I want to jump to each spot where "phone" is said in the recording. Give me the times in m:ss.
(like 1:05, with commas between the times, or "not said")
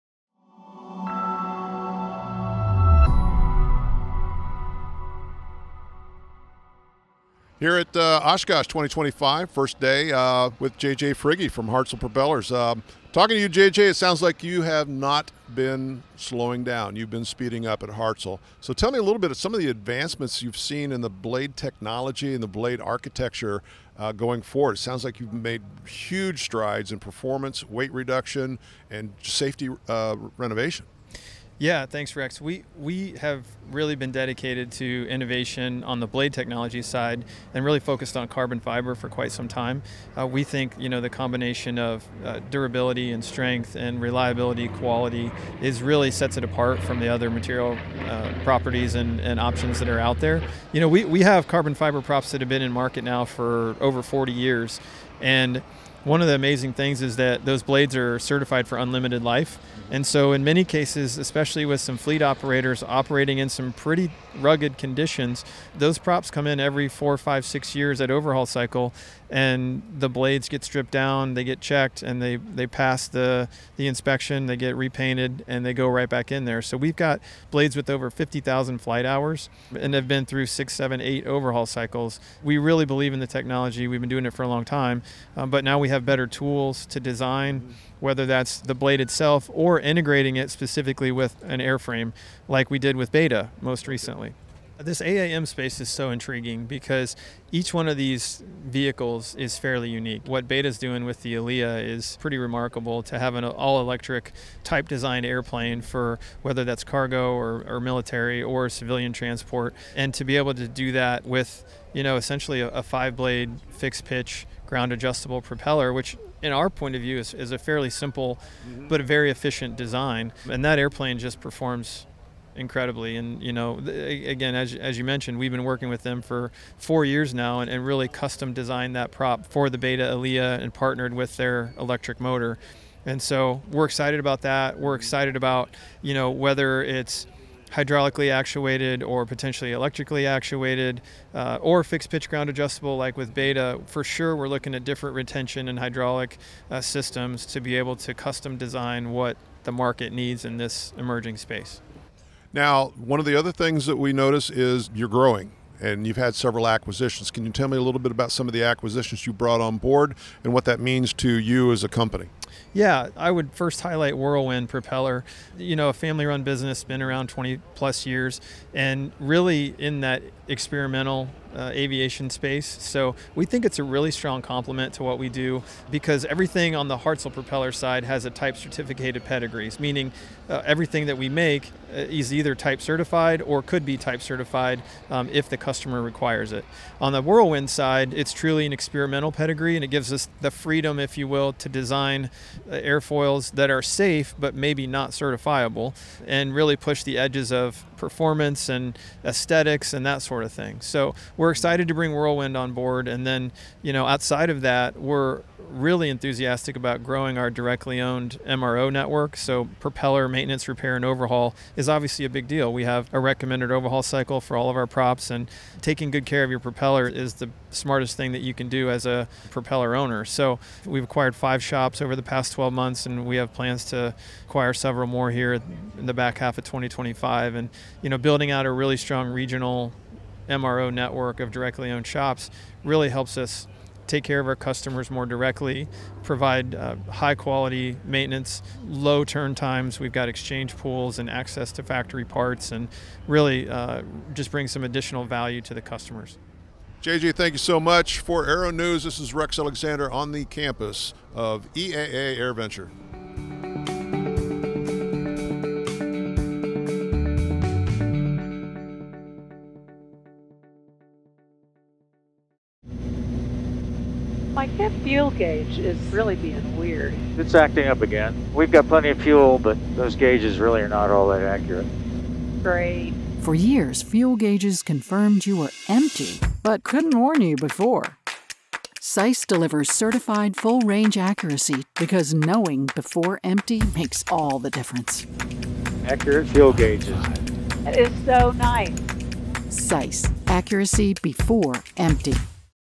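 not said.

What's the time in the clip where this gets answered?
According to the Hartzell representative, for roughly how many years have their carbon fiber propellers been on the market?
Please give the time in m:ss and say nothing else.
0:53.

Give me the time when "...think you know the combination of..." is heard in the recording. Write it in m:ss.
0:40.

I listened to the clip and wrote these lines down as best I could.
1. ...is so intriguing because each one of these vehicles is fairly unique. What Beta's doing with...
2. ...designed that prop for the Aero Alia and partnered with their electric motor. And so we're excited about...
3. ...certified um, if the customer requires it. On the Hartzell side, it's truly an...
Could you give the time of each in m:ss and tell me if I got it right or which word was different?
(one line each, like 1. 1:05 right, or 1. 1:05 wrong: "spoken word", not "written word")
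1. 1:35 right
2. 2:08 wrong: "Beta", not "Aero"
3. 3:04 wrong: "Whirlwind", not "Hartzell".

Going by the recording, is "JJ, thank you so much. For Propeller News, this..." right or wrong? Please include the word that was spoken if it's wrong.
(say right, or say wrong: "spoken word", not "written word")
wrong: "Aero", not "Propeller".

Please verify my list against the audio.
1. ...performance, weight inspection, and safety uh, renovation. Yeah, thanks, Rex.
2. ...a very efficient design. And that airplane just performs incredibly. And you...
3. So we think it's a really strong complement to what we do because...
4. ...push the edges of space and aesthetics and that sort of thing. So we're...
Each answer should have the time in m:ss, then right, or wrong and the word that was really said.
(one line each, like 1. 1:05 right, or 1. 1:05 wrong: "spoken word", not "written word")
1. 0:26 wrong: "reduction", not "inspection"
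2. 1:59 right
3. 2:52 right
4. 3:16 wrong: "performance", not "space".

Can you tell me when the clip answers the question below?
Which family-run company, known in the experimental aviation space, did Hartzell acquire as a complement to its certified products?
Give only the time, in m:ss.
2:44.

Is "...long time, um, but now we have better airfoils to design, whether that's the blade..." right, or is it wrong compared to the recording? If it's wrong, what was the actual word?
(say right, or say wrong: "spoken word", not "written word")
wrong: "tools", not "airfoils".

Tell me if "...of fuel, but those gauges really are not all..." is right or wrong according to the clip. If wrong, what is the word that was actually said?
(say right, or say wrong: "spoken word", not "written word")
right.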